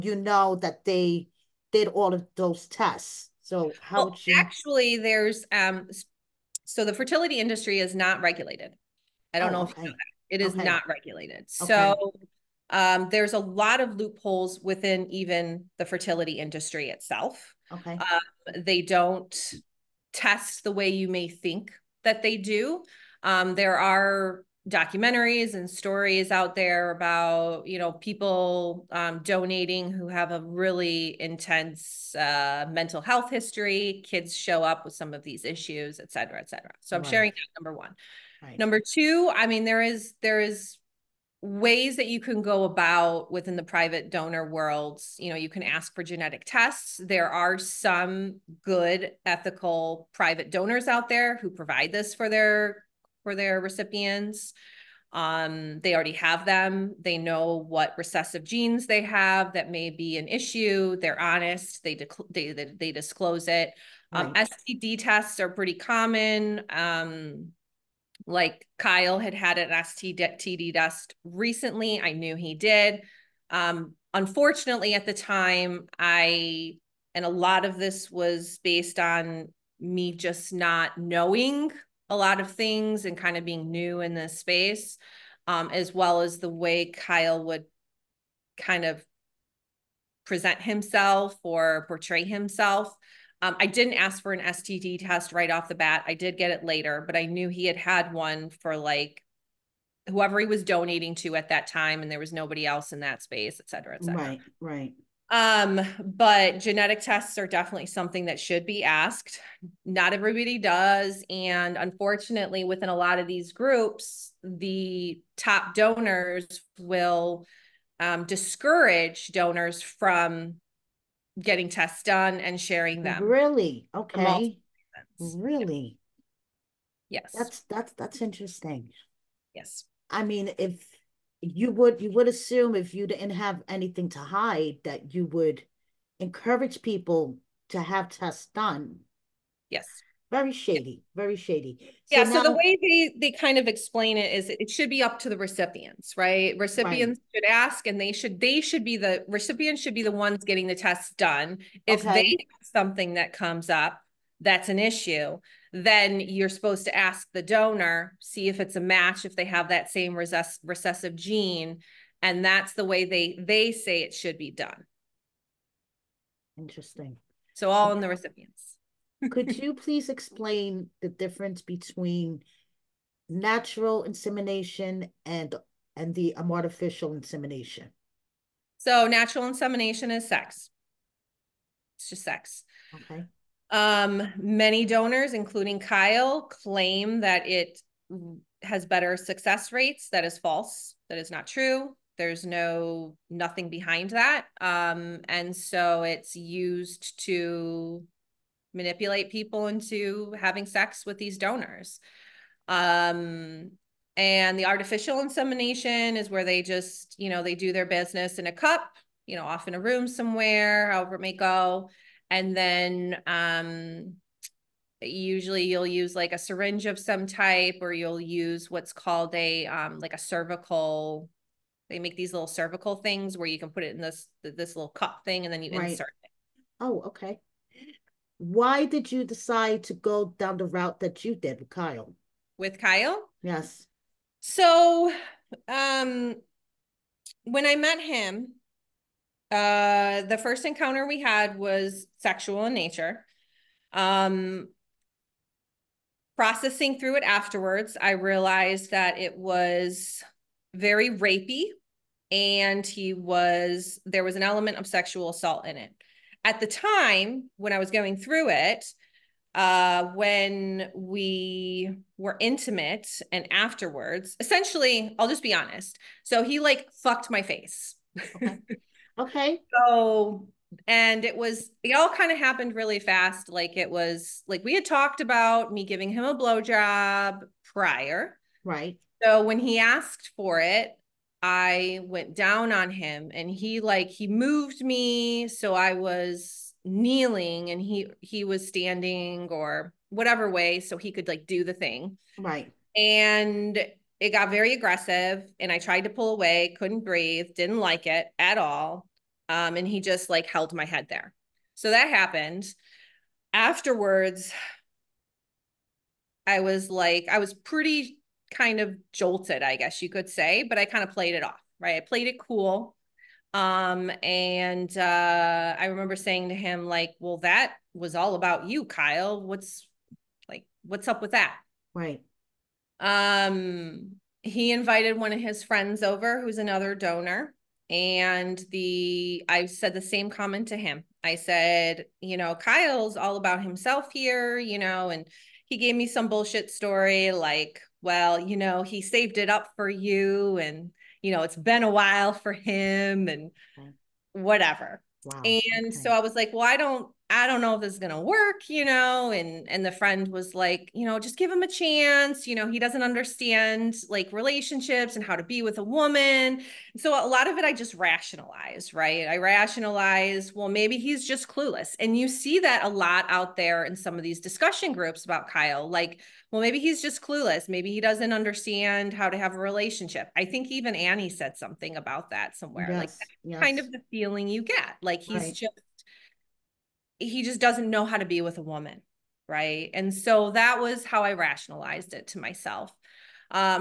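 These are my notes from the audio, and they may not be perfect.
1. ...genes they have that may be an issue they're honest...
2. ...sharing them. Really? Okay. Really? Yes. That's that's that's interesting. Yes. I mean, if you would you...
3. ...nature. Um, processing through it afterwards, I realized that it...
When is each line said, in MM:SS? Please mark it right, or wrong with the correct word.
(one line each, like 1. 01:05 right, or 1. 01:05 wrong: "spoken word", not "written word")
1. 00:58 right
2. 02:02 right
3. 04:02 right.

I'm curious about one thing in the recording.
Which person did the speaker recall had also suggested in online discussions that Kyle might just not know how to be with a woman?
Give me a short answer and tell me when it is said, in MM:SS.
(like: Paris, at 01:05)
Annie, at 06:10.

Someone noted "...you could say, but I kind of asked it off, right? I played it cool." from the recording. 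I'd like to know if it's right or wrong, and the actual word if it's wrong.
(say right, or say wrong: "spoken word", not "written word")
wrong: "played", not "asked".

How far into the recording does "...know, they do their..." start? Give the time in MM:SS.
03:27.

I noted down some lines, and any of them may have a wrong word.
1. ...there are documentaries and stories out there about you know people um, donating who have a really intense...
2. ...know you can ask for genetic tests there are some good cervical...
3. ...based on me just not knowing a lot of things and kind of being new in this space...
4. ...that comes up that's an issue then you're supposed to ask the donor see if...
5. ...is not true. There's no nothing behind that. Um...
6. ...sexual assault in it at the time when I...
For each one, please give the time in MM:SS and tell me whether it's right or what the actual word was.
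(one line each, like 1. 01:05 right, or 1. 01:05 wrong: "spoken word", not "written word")
1. 00:23 right
2. 00:45 wrong: "ethical", not "cervical"
3. 01:18 right
4. 02:33 right
5. 03:11 right
6. 04:14 right.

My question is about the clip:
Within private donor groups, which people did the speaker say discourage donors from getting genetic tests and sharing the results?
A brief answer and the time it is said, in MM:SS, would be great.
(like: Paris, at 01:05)
the top donors, at 01:54.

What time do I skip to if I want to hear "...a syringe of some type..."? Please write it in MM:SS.
03:36.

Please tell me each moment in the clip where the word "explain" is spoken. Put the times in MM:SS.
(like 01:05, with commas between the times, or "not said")
02:23, 02:50.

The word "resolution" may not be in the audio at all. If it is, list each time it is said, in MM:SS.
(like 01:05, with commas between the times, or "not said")
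not said.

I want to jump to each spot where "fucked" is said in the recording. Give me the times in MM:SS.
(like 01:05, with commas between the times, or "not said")
04:27.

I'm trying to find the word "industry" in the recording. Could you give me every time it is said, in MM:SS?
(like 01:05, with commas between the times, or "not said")
00:07, 00:16.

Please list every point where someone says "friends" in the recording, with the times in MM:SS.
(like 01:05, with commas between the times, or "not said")
05:25, 05:49.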